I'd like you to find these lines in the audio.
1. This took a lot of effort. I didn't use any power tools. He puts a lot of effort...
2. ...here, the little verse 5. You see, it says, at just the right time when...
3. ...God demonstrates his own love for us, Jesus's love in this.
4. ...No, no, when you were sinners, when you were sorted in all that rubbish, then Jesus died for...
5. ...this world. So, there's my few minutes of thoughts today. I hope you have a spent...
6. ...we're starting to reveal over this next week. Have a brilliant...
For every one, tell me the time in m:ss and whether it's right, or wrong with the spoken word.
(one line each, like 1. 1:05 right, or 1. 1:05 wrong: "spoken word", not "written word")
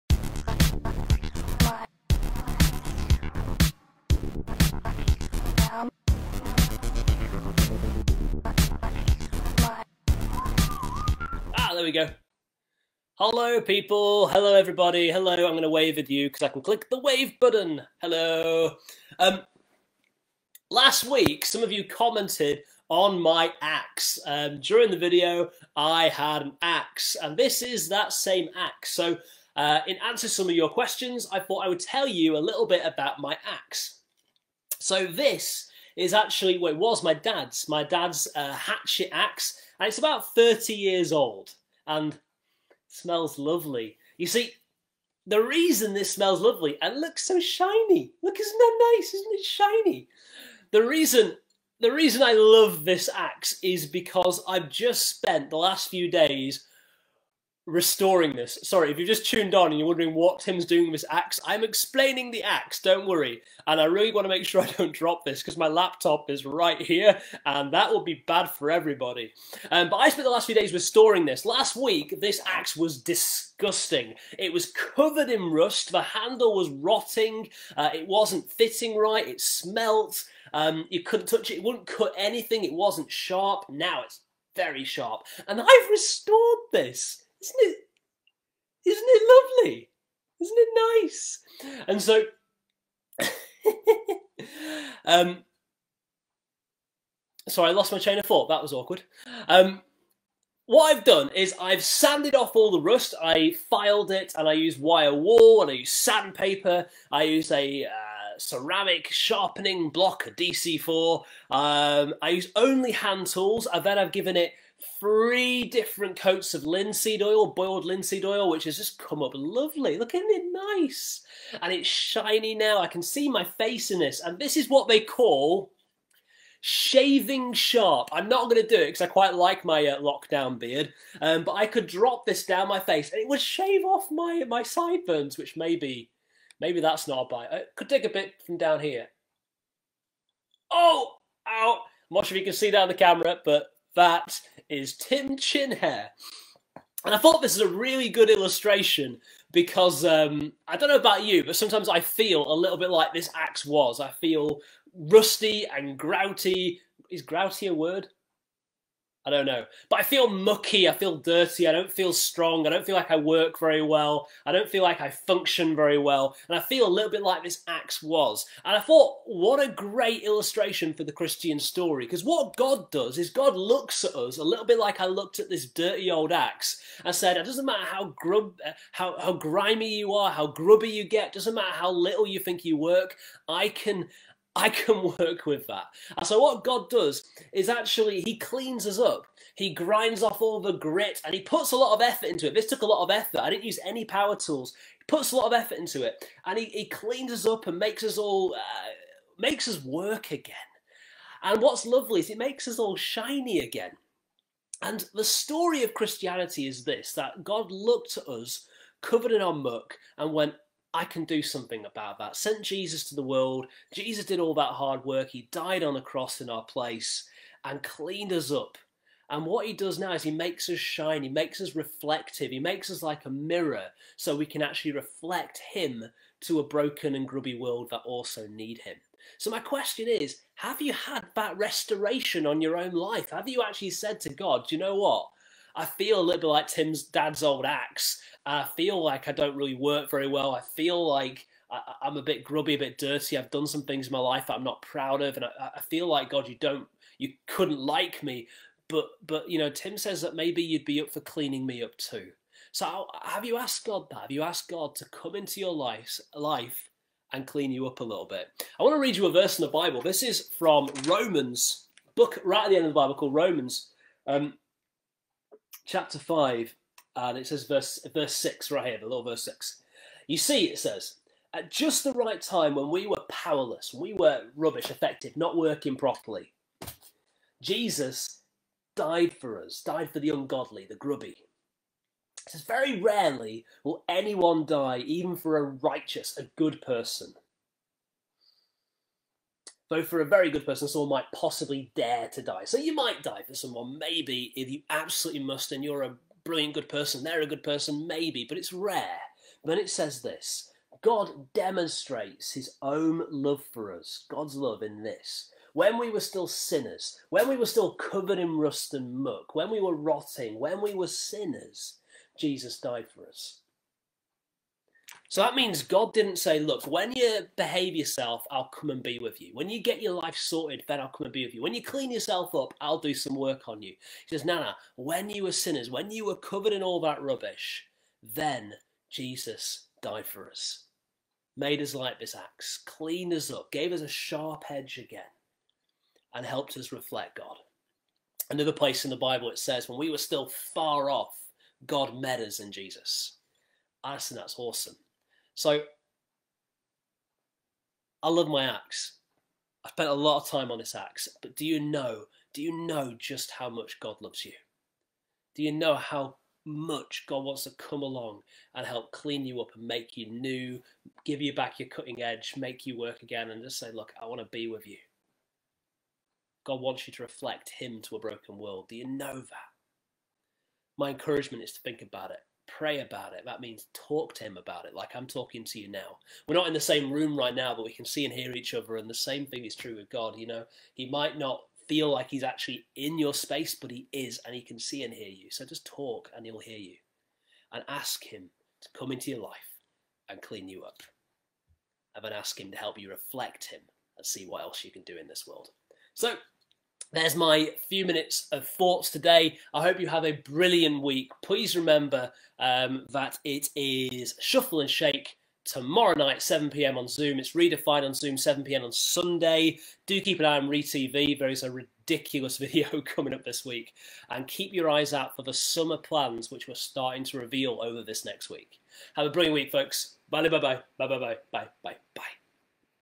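1. 3:12 right
2. 4:28 wrong: "6", not "5"
3. 5:01 wrong: "God", not "Jesus"
4. 5:24 wrong: "covered", not "sorted"
5. 6:35 wrong: "brilliant", not "spent"
6. 6:56 right.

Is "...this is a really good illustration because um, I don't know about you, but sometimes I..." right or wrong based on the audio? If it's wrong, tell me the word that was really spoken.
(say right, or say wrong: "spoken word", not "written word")
right.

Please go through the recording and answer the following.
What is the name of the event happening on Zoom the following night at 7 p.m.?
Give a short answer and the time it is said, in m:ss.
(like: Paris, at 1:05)
Shuffle and Shake, at 6:44.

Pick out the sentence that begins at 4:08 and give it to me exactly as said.
But but you know, Tim says that maybe you'd be up for cleaning me up too.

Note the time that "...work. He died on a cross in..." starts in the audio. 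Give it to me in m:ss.
3:35.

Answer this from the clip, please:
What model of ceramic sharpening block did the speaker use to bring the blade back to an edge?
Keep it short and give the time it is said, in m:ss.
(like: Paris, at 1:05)
DC4, at 1:50.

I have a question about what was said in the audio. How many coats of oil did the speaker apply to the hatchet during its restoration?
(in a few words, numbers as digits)
3.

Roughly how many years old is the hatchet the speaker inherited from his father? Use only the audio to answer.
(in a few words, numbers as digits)
30.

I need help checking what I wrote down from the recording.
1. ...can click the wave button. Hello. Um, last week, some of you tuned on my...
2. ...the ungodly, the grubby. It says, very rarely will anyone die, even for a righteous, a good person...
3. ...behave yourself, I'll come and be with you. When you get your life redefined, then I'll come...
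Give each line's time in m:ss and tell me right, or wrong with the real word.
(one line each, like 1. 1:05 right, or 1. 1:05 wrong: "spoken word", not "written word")
1. 0:16 wrong: "commented", not "tuned"
2. 4:40 right
3. 5:17 wrong: "sorted", not "redefined".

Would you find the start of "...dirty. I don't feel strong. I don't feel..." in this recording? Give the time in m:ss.
2:41.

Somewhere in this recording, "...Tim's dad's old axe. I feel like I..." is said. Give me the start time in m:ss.
3:56.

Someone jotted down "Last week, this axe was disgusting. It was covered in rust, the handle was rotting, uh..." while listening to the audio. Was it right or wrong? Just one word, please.
right.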